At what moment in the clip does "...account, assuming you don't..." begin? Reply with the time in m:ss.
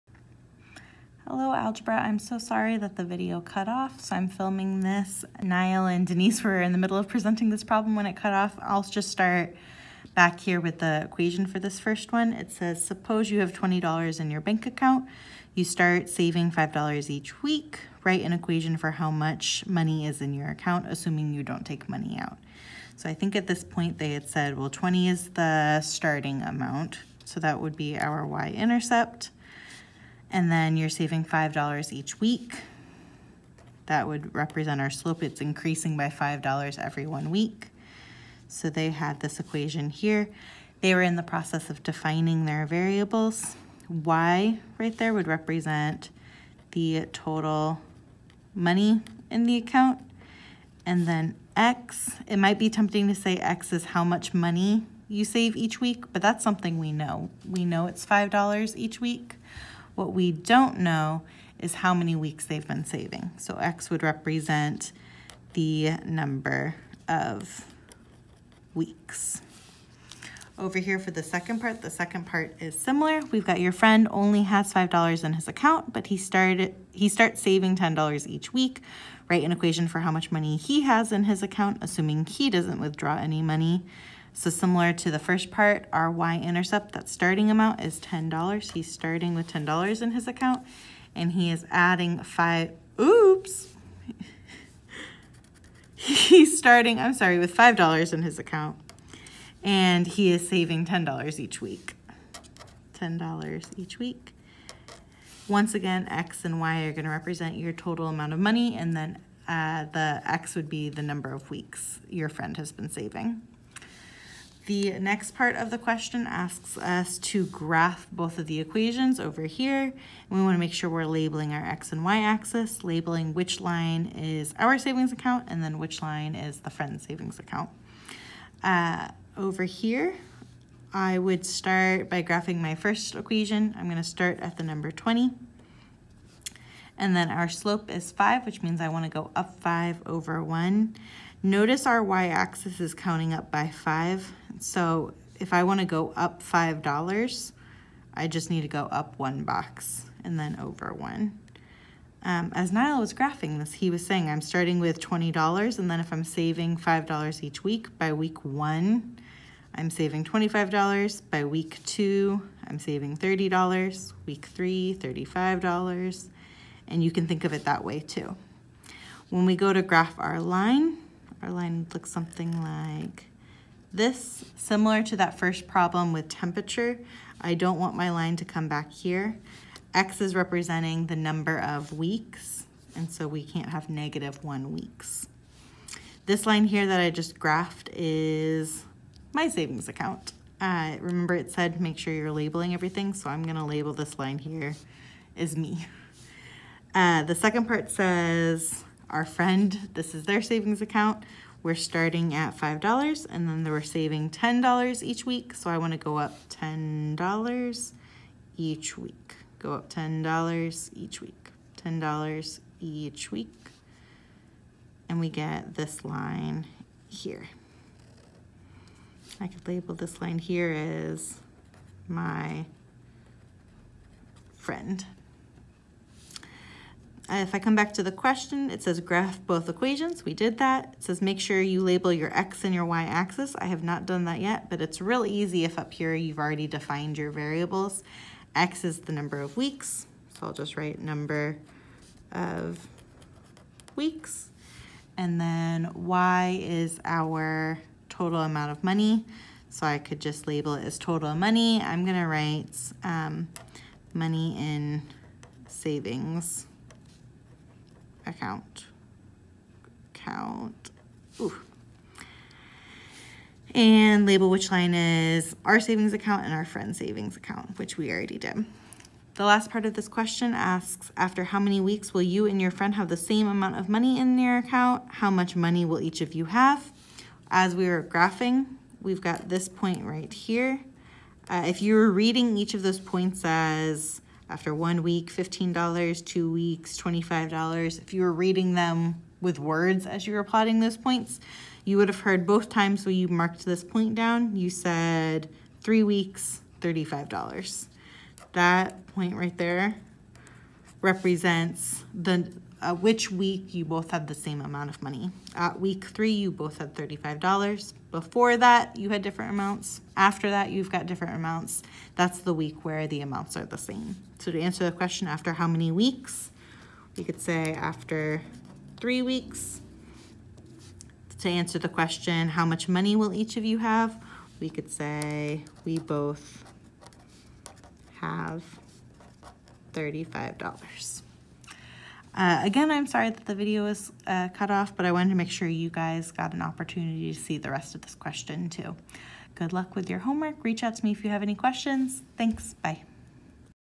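0:20.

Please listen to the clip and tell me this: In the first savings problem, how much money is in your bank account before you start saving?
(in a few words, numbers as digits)
$20.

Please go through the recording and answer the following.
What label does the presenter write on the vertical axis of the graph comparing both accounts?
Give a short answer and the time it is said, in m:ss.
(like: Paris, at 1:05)
money in savings account, at 4:14.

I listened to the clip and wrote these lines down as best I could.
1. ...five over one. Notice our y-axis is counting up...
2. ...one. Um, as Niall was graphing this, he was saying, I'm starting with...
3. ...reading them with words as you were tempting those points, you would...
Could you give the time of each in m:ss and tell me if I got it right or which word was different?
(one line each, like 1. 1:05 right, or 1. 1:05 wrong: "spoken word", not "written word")
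1. 2:19 right
2. 2:30 right
3. 4:48 wrong: "plotting", not "tempting".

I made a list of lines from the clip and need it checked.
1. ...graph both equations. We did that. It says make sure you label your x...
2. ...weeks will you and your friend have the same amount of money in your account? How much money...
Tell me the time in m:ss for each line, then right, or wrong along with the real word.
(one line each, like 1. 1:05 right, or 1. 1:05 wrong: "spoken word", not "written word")
1. 3:48 right
2. 4:31 right.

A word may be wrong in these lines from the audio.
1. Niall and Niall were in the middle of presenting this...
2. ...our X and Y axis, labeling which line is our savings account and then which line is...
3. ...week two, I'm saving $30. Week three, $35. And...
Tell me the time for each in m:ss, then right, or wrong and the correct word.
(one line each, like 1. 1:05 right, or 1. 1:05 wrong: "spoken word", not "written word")
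1. 0:05 wrong: "Denise", not "Niall"
2. 2:01 right
3. 2:41 right.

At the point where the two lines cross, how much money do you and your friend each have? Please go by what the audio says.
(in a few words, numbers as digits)
$35.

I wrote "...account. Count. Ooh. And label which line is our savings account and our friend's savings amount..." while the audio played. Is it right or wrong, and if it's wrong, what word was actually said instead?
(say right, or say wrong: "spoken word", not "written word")
wrong: "account", not "amount".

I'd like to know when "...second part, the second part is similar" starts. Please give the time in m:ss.
1:11.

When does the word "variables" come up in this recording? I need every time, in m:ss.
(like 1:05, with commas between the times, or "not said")
0:42, 3:57.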